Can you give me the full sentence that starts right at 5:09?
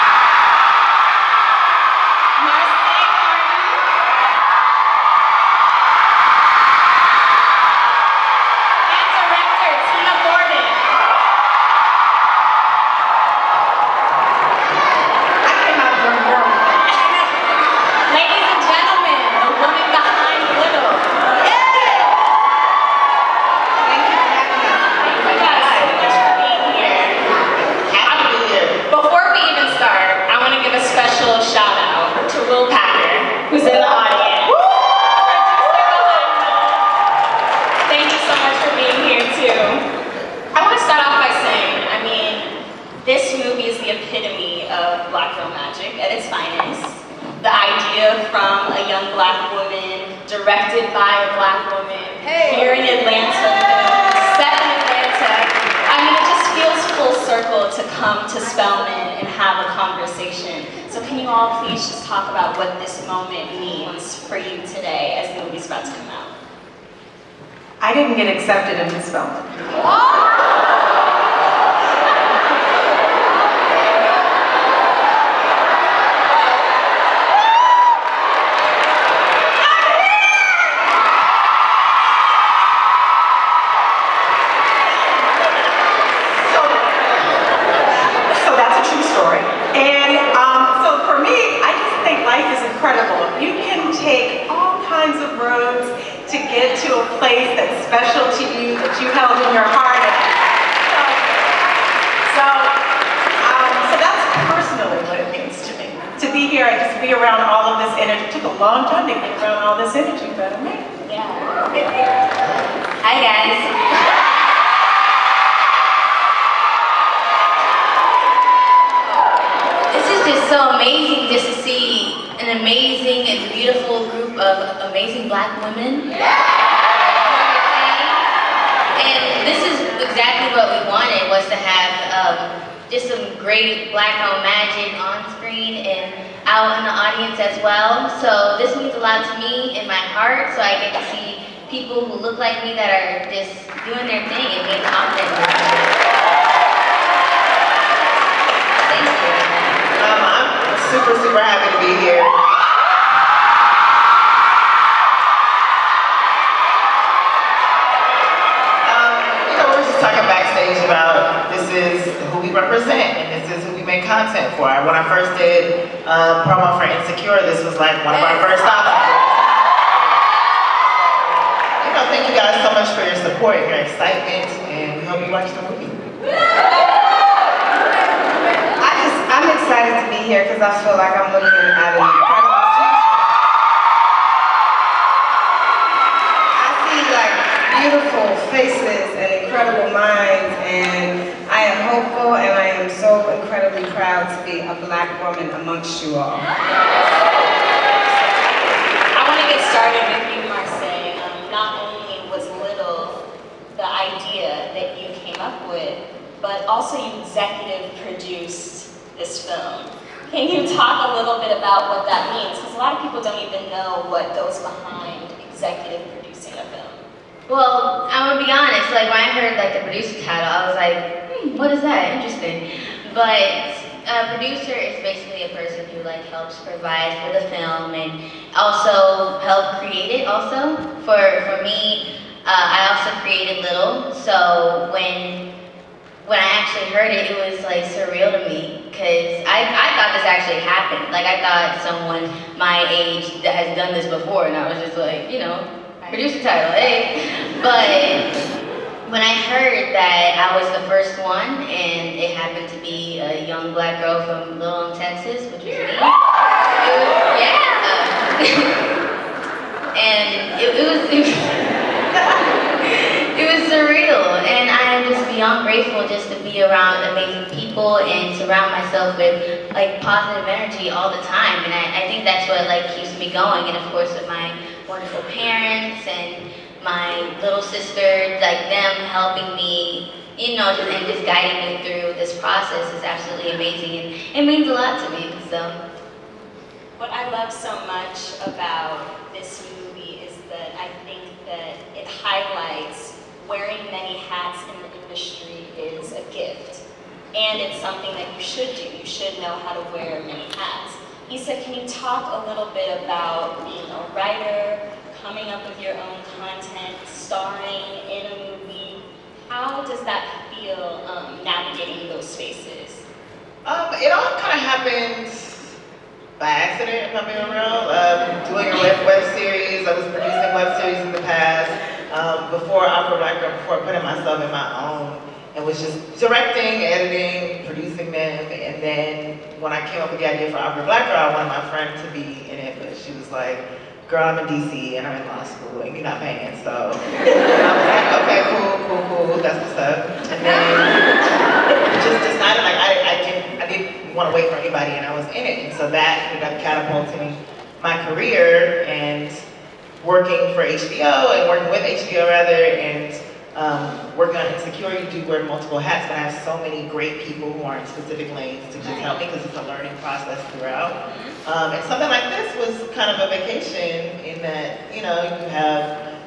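How does that feel um, navigating those spaces?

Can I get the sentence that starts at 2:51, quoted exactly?
You know, thank you guys so much for your support, your excitement, and we hope you watch the movie.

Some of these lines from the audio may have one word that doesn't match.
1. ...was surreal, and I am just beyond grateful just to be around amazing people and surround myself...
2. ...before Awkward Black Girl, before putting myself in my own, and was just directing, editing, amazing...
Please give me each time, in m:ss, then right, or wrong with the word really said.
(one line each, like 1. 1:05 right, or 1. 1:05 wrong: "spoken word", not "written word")
1. 4:23 right
2. 5:22 wrong: "producing", not "amazing".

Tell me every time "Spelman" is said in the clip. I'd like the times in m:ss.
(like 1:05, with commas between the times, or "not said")
0:58, 1:09.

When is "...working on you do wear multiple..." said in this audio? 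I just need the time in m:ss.
5:54.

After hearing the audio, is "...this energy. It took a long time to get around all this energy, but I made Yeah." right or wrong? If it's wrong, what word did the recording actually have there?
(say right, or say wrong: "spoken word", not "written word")
right.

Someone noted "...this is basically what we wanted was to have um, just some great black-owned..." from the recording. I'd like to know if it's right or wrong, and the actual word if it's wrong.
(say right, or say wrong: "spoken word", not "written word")
wrong: "exactly", not "basically".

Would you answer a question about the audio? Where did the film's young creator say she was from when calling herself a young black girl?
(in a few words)
Little Texas.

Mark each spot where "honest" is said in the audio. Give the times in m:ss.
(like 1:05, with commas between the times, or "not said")
3:38.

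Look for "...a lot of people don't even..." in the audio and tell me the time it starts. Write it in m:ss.
3:32.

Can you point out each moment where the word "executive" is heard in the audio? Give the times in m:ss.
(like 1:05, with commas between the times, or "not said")
3:27, 3:35.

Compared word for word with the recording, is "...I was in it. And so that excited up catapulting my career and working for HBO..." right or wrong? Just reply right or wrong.
wrong.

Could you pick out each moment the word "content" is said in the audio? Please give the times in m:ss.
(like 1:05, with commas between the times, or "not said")
2:44, 5:06.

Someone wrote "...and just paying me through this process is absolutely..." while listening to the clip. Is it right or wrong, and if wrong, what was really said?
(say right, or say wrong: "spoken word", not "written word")
wrong: "guiding", not "paying".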